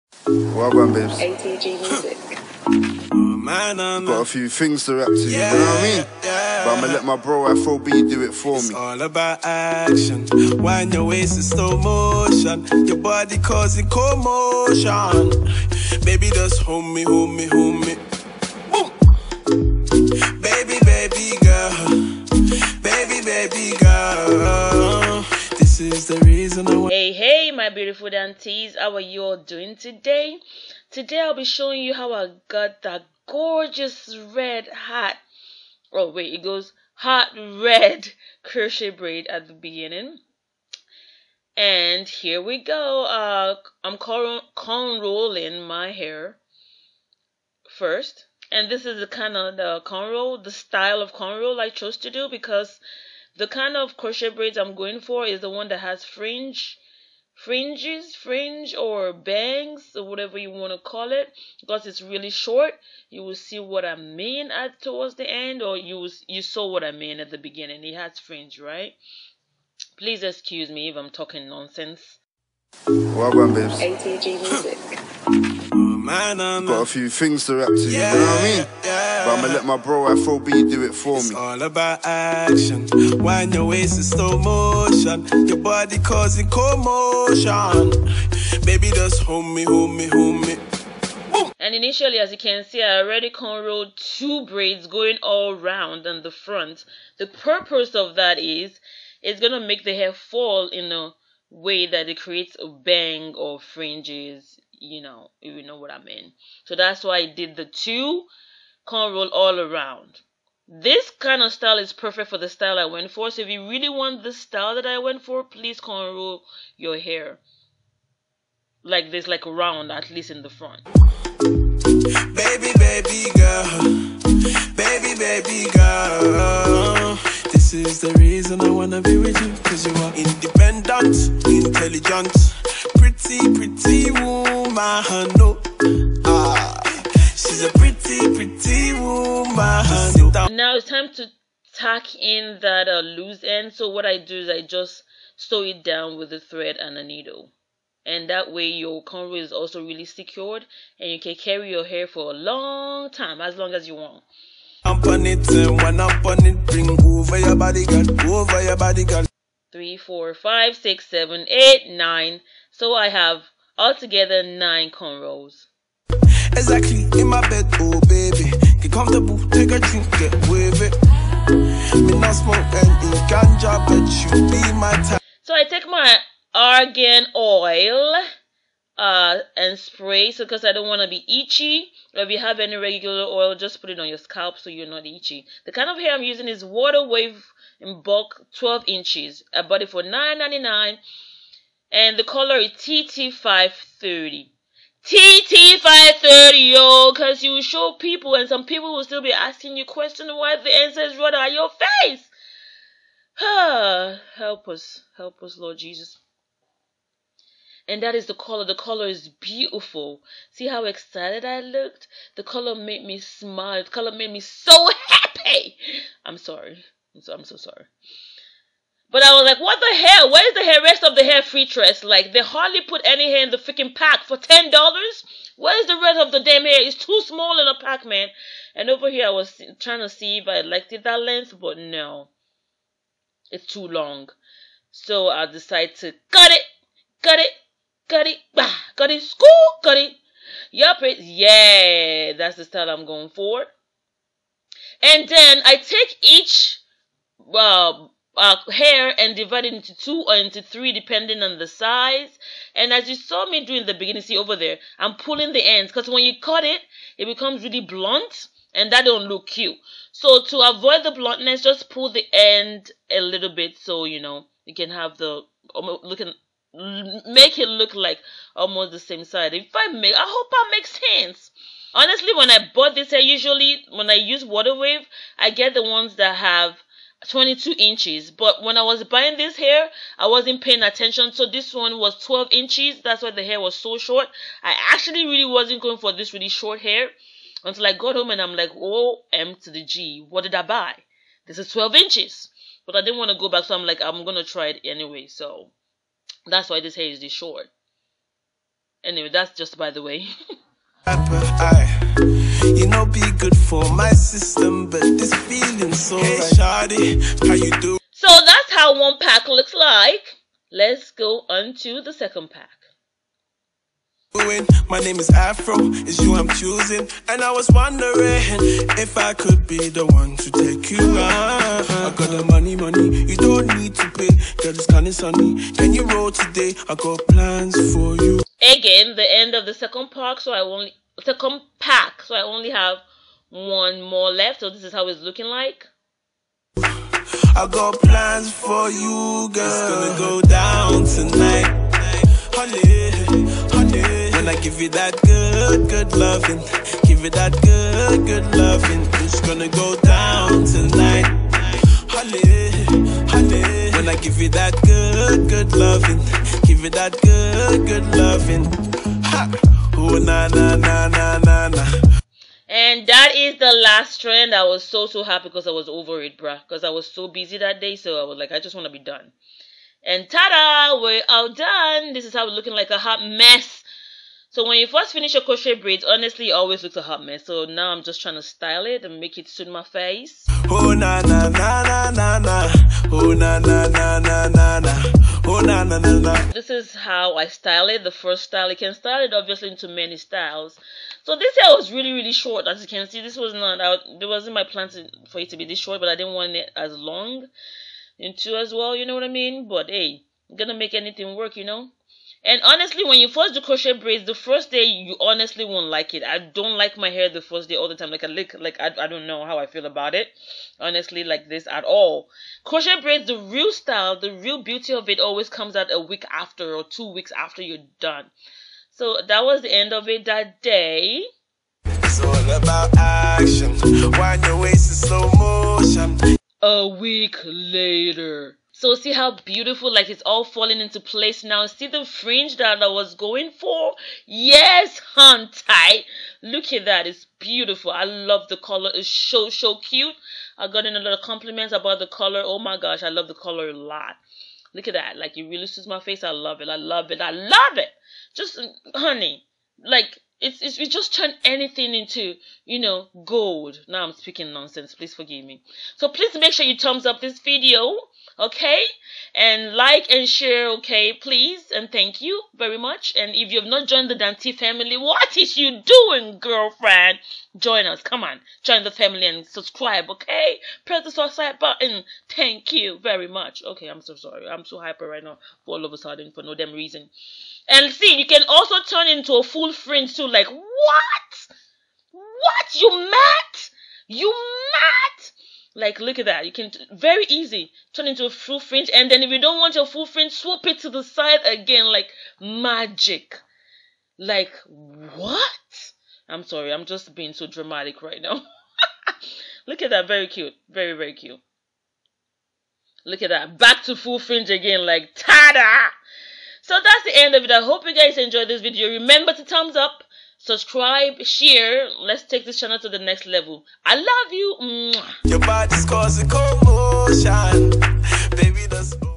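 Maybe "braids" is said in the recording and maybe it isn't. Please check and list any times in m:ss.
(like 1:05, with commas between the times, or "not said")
0:38, 0:54, 1:34, 6:15, 6:43, 6:52.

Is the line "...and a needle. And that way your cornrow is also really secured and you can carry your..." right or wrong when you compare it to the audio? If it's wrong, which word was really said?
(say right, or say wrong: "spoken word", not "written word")
right.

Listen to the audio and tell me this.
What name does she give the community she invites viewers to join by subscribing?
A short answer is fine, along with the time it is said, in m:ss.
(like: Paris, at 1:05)
DanTemmy family, at 7:44.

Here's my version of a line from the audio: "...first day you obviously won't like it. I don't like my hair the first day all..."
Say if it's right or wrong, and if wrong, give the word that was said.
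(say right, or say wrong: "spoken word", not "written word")
wrong: "honestly", not "obviously".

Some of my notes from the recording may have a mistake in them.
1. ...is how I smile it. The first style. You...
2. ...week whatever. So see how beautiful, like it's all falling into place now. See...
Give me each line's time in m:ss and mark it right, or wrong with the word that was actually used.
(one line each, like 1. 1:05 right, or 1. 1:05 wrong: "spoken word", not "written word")
1. 6:26 wrong: "style", not "smile"
2. 7:06 wrong: "later", not "whatever".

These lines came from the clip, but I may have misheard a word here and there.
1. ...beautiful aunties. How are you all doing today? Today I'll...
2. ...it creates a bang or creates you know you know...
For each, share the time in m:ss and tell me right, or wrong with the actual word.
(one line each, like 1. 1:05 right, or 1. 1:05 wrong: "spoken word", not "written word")
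1. 0:27 right
2. 1:42 wrong: "fringes", not "creates".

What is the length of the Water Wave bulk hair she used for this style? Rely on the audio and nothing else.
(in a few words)
12 inches.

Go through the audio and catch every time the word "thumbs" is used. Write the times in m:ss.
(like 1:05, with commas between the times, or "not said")
7:36, 8:29.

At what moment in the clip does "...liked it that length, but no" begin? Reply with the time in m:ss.
3:50.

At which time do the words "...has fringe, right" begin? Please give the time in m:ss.
1:07.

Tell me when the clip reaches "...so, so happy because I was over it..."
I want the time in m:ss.
6:04.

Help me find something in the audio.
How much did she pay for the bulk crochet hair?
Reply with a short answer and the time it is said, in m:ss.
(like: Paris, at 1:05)
$9.99, at 3:10.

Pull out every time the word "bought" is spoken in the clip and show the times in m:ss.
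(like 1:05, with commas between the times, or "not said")
3:09, 4:32.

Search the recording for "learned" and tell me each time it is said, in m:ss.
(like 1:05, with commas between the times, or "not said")
not said.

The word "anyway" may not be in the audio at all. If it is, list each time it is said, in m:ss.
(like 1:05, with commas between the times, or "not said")
4:54, 4:59.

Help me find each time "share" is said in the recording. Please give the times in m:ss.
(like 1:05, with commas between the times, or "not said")
7:40, 8:31.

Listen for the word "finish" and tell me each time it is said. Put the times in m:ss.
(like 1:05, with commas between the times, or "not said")
6:15.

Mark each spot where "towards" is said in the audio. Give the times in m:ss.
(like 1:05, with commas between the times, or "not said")
1:04.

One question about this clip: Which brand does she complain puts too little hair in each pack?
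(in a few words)
FreeTress.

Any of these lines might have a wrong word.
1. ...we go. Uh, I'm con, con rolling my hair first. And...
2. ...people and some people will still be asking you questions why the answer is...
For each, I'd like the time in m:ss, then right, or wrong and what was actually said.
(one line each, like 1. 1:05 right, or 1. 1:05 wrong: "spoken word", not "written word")
1. 0:42 right
2. 3:17 right.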